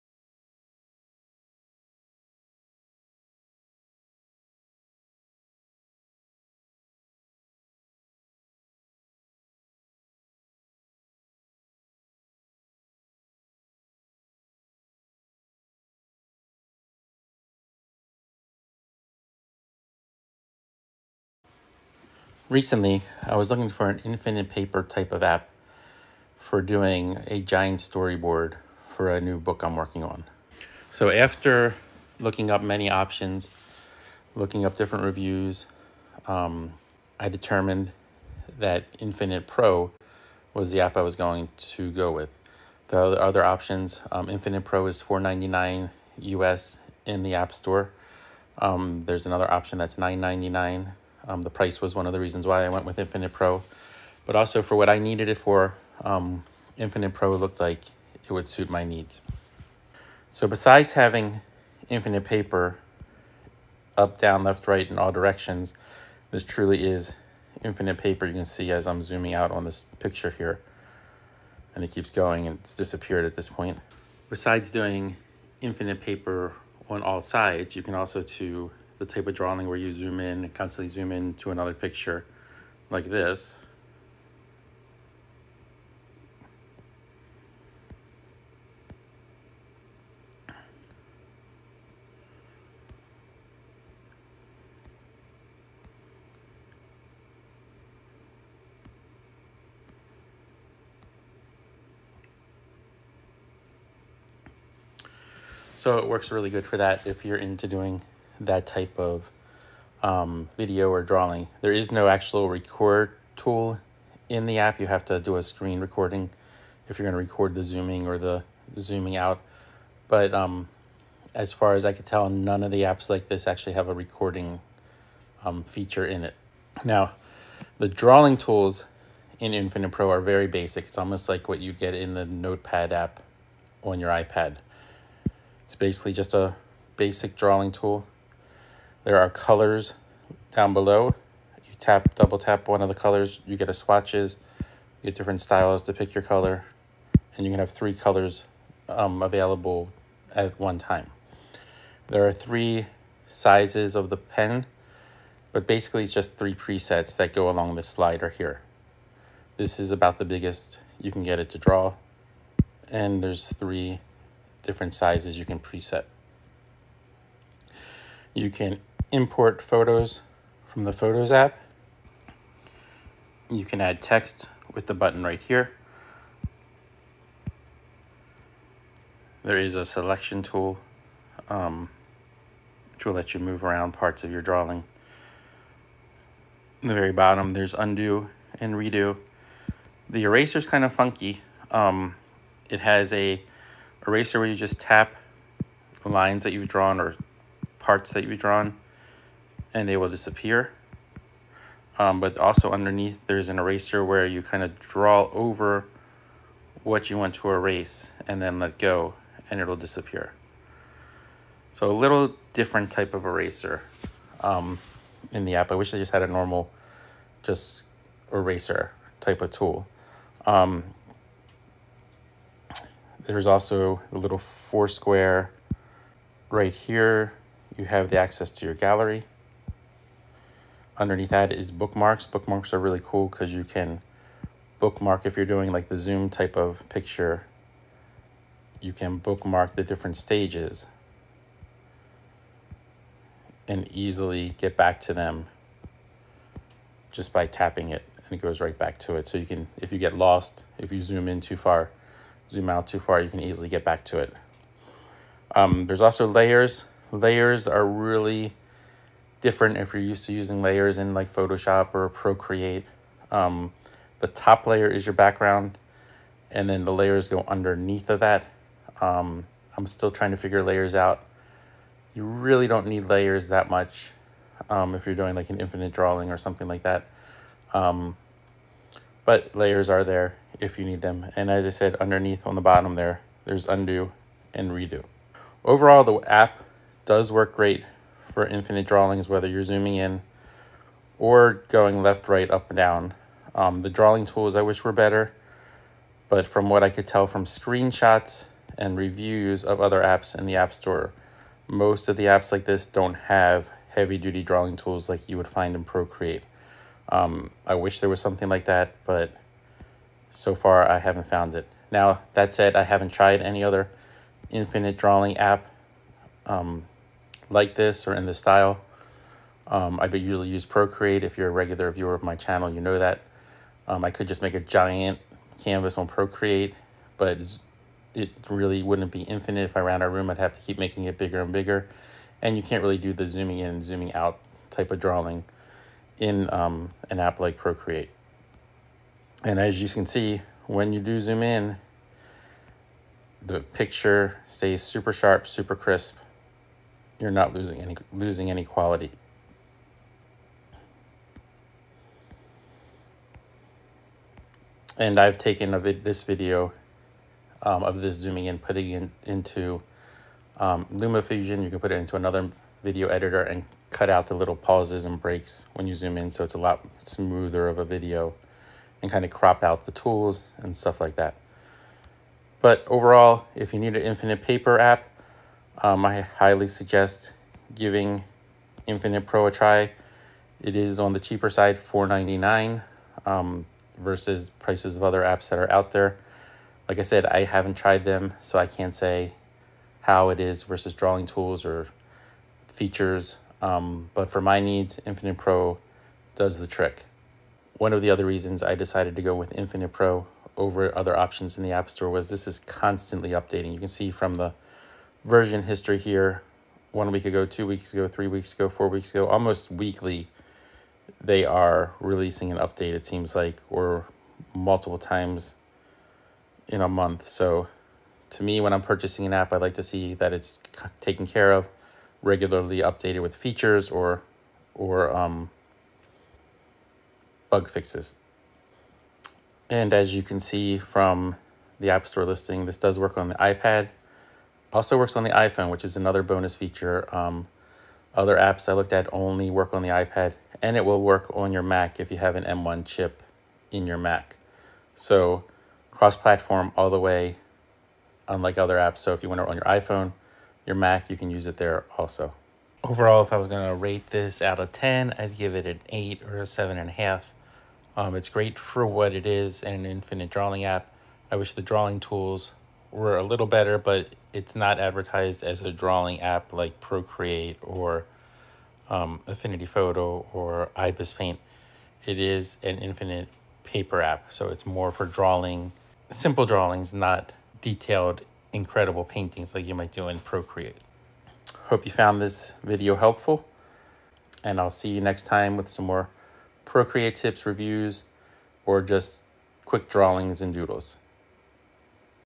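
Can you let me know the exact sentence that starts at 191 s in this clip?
Um, it has a eraser where you just tap lines that you've drawn or parts that you've drawn and they will disappear.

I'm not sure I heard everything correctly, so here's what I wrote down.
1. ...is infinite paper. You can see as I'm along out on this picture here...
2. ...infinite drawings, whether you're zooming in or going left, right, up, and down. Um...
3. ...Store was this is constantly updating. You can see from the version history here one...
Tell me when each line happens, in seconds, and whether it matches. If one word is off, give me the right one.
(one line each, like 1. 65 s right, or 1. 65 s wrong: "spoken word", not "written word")
1. 66 s wrong: "zooming", not "along"
2. 288 s right
3. 401 s right.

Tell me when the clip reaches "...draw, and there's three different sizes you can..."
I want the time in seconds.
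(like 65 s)
161 s.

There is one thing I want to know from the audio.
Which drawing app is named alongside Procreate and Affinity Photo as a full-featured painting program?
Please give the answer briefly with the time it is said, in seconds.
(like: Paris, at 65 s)
Ibis Paint, at 470 s.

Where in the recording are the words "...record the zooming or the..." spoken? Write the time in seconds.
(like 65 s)
117 s.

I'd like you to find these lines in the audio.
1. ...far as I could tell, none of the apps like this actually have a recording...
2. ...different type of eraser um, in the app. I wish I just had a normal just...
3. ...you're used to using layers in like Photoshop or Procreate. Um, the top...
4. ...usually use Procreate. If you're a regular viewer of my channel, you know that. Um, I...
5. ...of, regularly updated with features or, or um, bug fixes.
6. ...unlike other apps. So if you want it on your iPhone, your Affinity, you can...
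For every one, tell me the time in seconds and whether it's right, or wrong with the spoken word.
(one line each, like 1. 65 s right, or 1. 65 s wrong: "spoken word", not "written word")
1. 121 s right
2. 212 s right
3. 259 s right
4. 320 s right
5. 421 s right
6. 448 s wrong: "Mac", not "Affinity".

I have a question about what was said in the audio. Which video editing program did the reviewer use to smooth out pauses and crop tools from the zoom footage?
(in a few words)
LumaFusion.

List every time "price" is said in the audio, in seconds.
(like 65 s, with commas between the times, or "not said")
51 s, 384 s.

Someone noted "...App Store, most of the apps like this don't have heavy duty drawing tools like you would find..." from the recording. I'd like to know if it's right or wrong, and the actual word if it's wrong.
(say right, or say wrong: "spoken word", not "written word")
right.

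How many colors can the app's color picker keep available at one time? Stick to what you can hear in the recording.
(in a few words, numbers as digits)
3.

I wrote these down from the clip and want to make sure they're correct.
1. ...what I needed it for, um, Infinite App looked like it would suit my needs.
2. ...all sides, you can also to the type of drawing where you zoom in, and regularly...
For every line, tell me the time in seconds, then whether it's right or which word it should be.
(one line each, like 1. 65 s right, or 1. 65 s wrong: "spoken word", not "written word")
1. 54 s wrong: "Pro", not "App"
2. 77 s wrong: "constantly", not "regularly".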